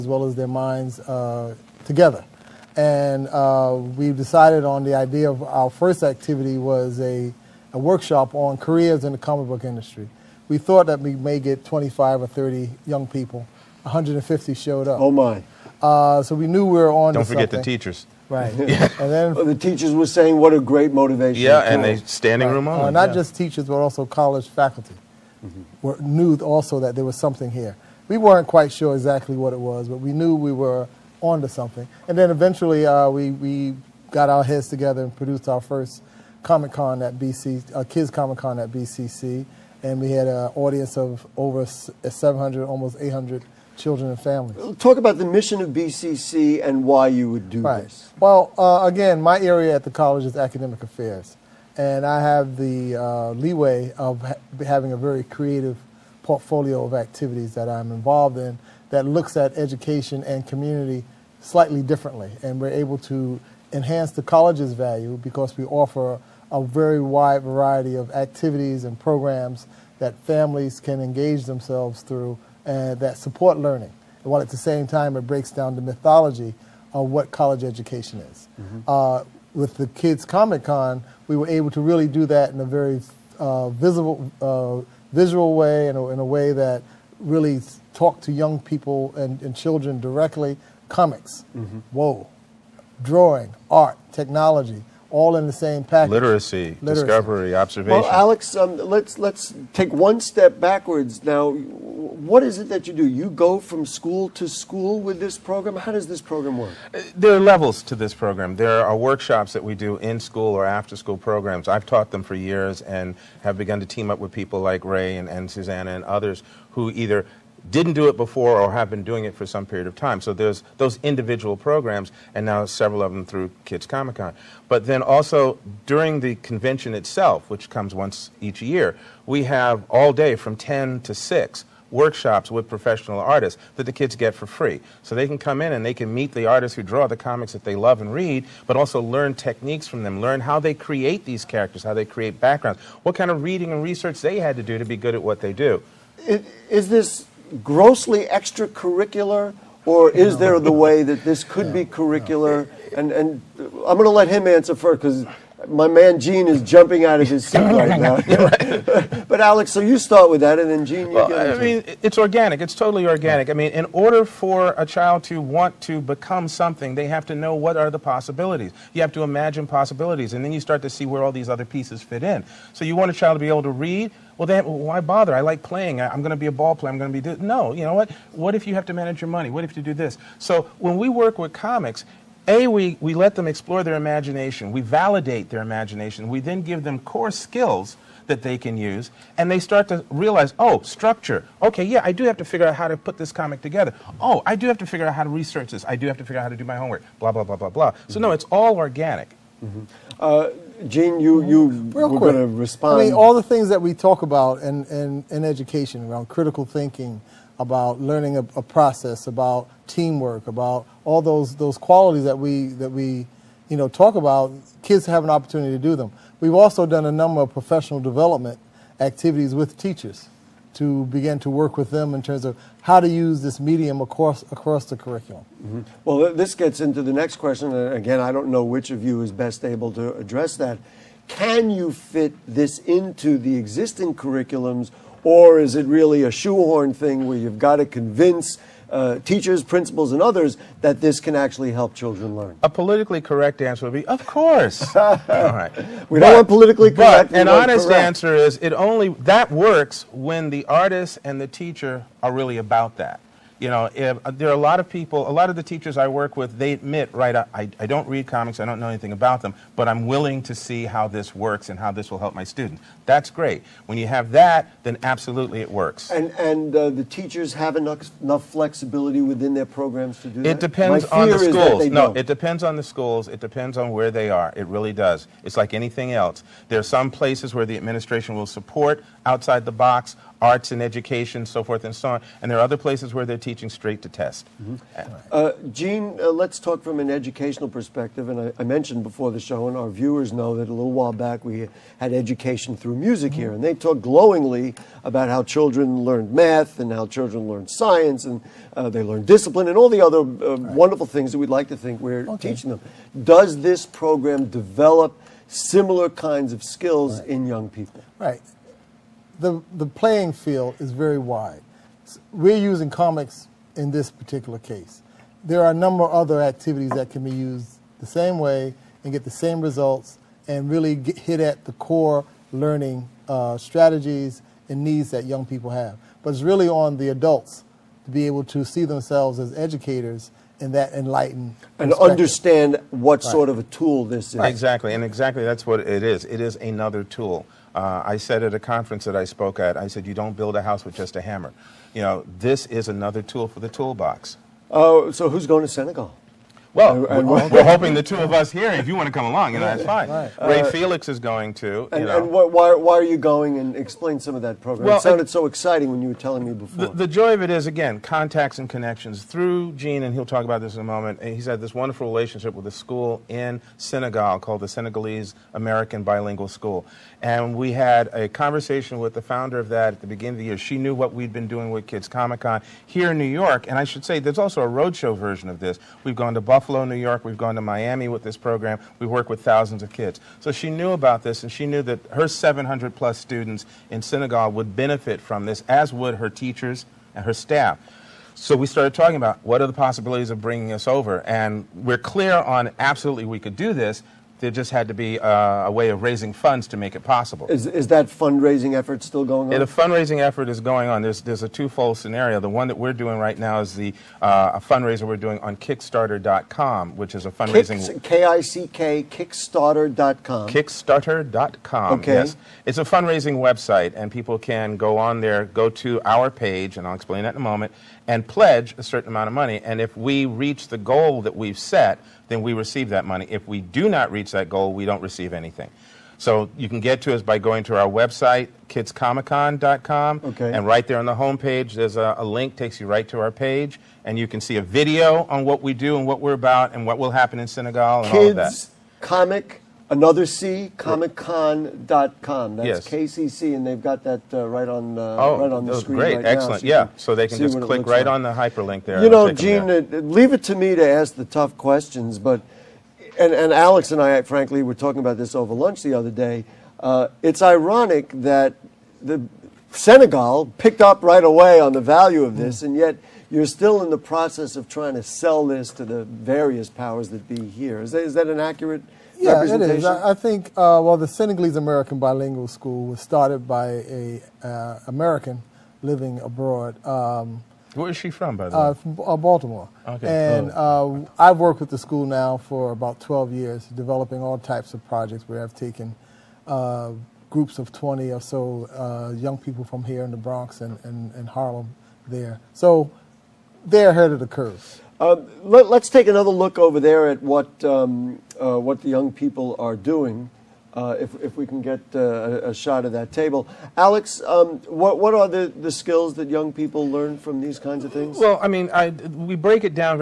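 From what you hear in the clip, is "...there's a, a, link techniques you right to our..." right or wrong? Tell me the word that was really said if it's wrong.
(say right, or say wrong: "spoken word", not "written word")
wrong: "takes", not "techniques".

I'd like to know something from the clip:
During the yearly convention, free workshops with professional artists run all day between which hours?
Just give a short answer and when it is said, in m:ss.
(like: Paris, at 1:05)
10 to 6, at 2:10.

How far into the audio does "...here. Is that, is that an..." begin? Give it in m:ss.
7:47.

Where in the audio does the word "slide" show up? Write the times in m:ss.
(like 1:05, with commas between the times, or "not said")
not said.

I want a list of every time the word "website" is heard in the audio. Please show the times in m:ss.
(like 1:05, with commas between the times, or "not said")
6:53, 7:07.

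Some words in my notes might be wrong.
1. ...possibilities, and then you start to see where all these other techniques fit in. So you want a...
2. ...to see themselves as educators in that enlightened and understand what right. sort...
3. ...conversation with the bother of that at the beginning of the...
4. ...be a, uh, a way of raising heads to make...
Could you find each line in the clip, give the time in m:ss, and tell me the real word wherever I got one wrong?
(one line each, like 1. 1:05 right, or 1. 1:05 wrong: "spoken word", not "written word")
1. 2:49 wrong: "pieces", not "techniques"
2. 5:28 right
3. 6:08 wrong: "founder", not "bother"
4. 6:34 wrong: "funds", not "heads".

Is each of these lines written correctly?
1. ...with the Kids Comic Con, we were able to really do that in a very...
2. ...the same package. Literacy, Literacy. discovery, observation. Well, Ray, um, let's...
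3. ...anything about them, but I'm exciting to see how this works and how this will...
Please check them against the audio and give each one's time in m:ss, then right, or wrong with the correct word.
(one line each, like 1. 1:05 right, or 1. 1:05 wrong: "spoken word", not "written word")
1. 1:19 right
2. 1:35 wrong: "Alex", not "Ray"
3. 4:18 wrong: "willing", not "exciting".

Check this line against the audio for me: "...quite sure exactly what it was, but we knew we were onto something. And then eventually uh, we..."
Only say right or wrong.
right.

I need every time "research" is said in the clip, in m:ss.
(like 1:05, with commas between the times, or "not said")
2:23, 3:15.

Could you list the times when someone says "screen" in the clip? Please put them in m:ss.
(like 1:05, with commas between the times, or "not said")
7:25.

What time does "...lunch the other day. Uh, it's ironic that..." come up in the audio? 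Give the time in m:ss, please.
7:35.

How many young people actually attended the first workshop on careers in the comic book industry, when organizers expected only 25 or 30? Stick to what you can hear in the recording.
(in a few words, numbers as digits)
150.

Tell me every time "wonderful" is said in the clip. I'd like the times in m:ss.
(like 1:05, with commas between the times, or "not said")
5:00, 6:01.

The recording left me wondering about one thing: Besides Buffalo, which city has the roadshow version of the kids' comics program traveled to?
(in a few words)
Miami.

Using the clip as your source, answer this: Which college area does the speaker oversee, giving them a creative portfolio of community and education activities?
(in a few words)
Academic affairs.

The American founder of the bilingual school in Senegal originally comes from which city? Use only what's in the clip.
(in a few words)
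Baltimore.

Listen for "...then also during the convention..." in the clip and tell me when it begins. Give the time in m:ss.
2:04.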